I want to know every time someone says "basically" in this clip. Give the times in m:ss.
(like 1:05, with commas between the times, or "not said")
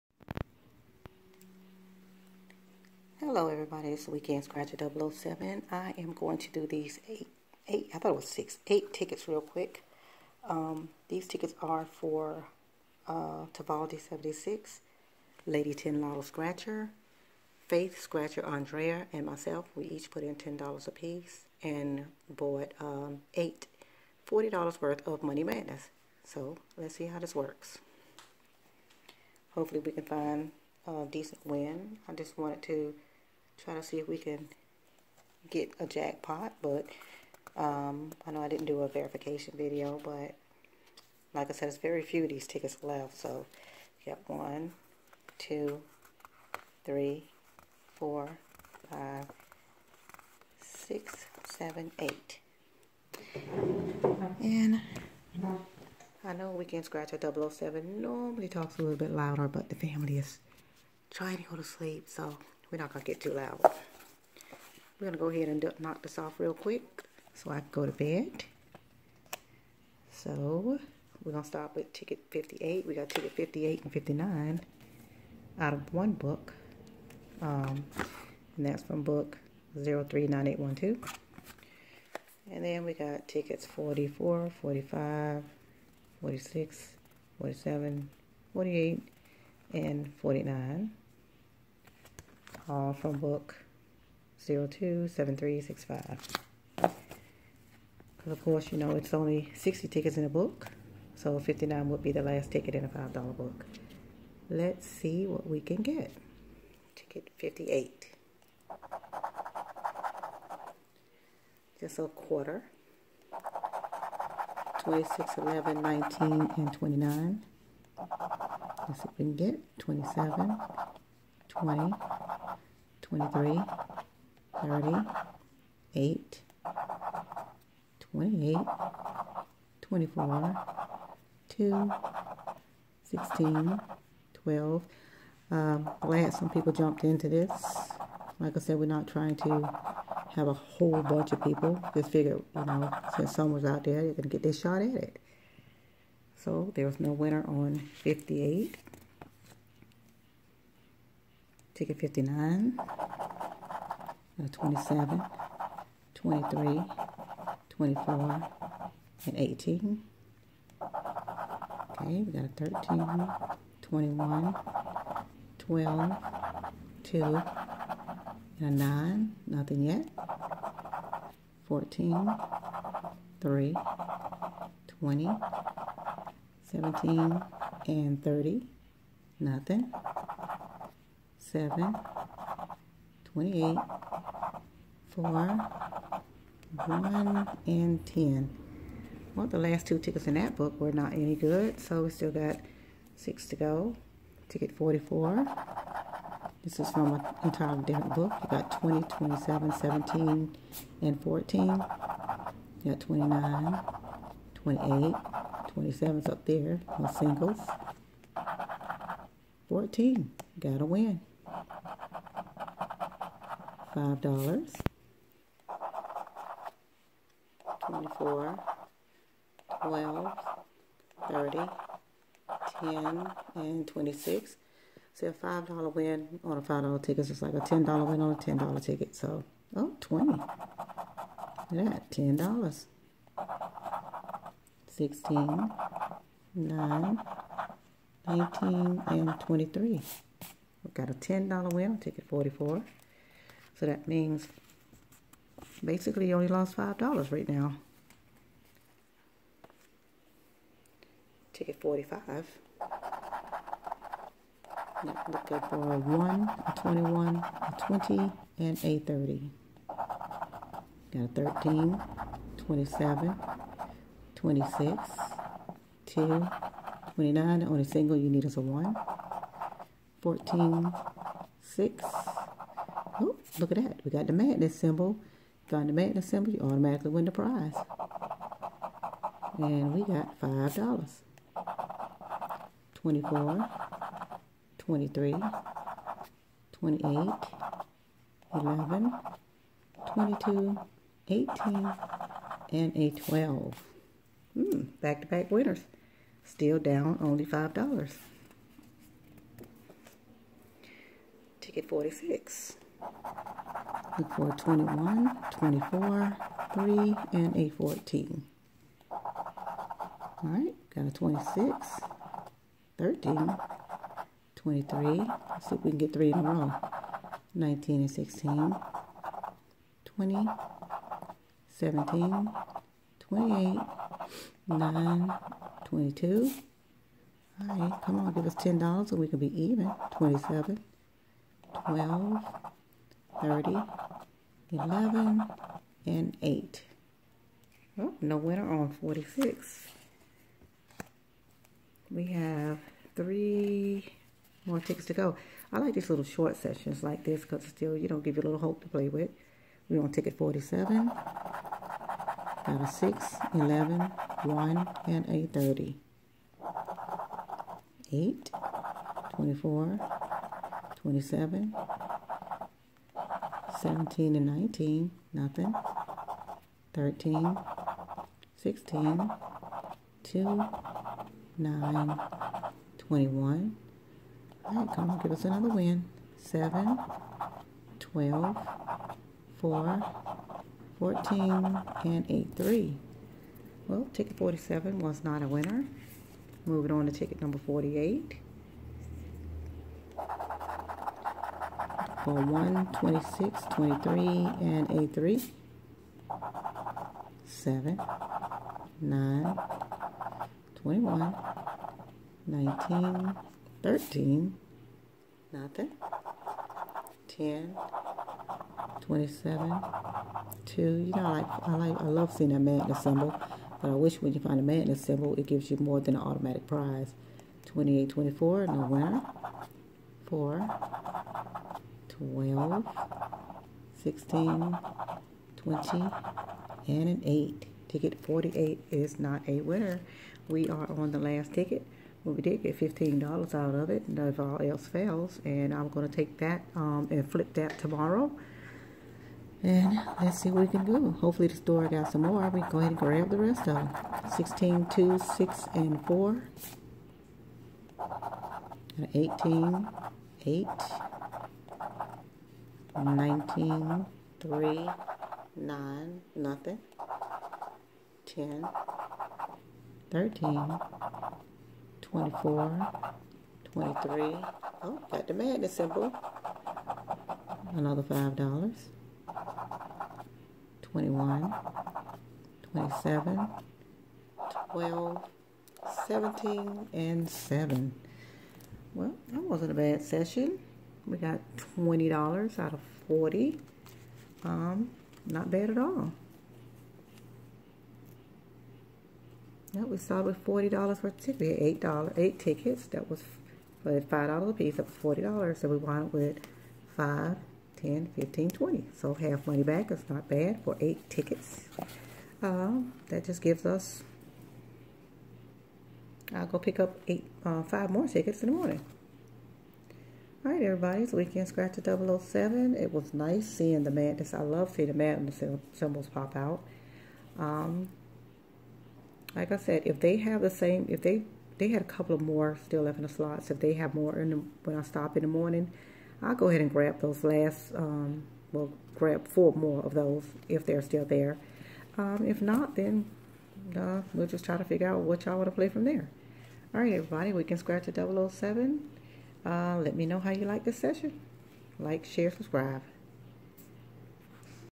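4:05.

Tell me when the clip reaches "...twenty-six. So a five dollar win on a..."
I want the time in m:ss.
3:43.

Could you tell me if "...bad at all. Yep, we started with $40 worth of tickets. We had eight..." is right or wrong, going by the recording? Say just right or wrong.
right.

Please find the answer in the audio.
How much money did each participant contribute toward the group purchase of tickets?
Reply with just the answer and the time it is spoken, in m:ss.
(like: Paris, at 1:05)
$10, at 0:20.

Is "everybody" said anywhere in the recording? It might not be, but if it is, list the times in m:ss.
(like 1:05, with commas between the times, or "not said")
0:03, 8:30, 8:56.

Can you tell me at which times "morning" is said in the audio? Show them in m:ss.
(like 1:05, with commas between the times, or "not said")
8:28, 8:45.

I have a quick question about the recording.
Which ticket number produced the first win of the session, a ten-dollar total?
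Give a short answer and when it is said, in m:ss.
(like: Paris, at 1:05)
44, at 4:01.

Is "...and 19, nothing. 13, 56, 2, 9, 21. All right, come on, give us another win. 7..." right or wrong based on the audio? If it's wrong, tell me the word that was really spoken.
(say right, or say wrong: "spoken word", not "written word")
wrong: "16", not "56".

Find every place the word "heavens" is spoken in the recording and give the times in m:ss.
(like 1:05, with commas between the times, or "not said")
not said.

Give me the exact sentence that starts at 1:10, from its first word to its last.
So we're going to start with ticket 58.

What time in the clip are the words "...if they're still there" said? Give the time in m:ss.
8:50.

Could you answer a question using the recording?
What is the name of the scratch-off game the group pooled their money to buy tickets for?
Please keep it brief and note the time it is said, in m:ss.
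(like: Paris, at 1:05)
Money Madness, at 0:25.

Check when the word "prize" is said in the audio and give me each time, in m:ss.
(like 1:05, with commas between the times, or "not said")
4:37, 6:56.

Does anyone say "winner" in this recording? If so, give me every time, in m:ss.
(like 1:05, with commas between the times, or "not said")
2:27, 4:55, 5:38, 6:25, 6:58, 7:09.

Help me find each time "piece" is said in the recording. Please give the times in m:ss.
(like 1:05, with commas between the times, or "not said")
0:20, 8:14.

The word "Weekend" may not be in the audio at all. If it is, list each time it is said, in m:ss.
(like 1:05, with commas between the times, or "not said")
0:04, 0:56, 8:31, 8:57.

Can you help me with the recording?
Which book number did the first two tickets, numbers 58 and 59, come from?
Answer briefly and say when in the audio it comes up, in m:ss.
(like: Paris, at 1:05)
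039812, at 1:19.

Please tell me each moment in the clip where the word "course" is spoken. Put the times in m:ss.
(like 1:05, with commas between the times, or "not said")
1:38.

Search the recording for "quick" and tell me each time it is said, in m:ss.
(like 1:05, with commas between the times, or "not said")
0:09, 1:06.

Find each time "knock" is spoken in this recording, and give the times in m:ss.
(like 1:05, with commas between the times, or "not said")
1:05.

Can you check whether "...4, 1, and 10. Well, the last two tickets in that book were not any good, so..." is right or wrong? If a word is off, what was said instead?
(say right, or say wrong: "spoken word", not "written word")
right.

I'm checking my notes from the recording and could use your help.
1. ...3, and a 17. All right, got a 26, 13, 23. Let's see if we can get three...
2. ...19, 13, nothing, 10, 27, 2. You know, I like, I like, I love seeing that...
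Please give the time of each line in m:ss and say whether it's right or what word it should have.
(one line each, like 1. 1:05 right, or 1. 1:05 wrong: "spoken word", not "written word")
1. 5:06 wrong: "14", not "17"
2. 6:42 right.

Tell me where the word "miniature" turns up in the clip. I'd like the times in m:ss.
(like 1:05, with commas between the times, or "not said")
not said.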